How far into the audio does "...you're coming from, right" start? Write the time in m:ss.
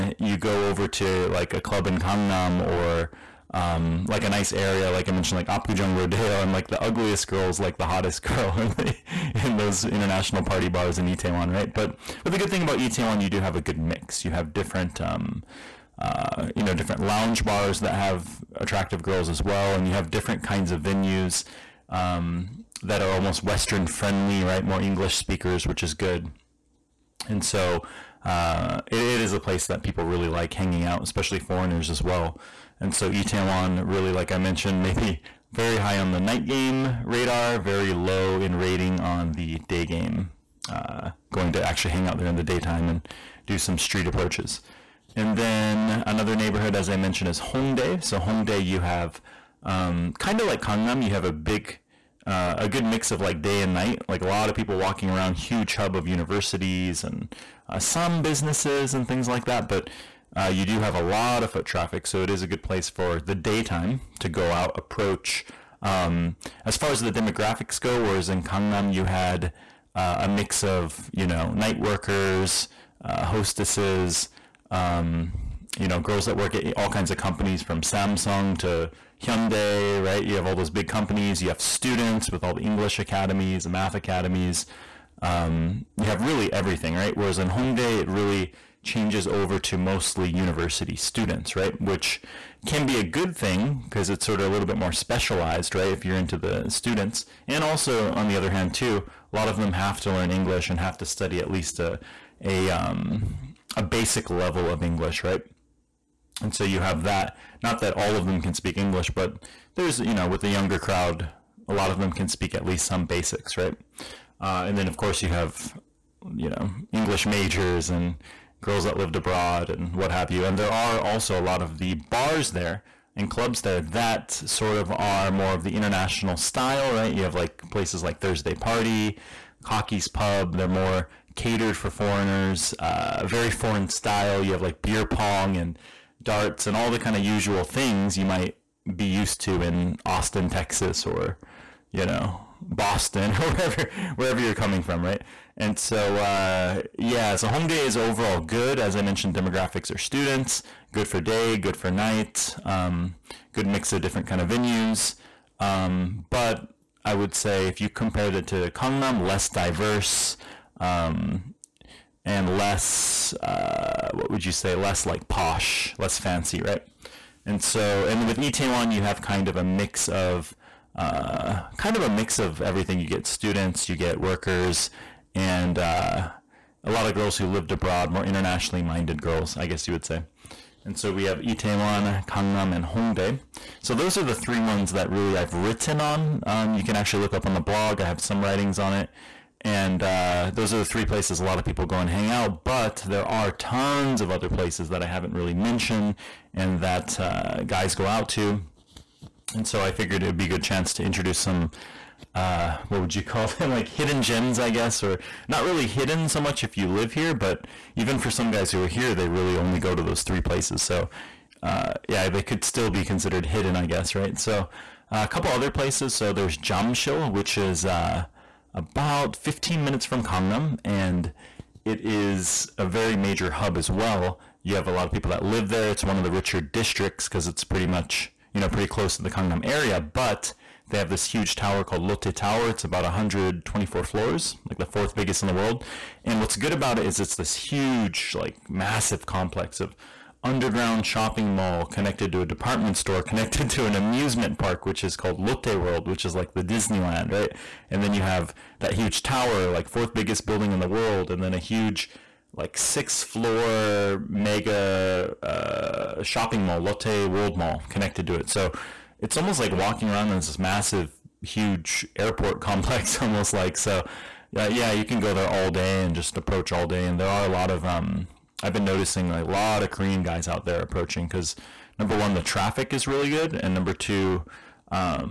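2:24.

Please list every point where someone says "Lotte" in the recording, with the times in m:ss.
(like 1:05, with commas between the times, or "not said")
3:52, 4:05, 4:16.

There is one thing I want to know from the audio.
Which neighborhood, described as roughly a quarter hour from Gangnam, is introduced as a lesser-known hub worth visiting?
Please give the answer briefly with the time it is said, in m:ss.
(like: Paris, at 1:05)
Jamshil, at 3:36.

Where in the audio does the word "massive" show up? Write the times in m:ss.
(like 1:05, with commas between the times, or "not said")
3:58, 4:20.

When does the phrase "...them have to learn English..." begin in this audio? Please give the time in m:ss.
1:39.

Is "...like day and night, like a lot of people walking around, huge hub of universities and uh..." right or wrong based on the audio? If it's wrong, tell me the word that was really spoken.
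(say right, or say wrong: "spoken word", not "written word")
right.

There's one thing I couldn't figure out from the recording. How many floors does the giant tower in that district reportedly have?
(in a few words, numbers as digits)
124.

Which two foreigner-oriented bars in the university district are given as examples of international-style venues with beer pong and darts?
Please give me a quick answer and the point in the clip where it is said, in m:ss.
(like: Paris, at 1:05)
Thursday Party, Cocky's Pub, at 2:08.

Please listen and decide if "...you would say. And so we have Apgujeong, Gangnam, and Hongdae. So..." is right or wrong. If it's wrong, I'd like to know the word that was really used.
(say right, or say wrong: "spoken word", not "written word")
wrong: "Itaewon", not "Apgujeong".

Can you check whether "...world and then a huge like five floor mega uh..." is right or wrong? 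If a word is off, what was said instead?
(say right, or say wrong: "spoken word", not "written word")
wrong: "six", not "five".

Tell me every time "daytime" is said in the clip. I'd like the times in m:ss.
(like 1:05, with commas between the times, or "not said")
0:42, 1:03.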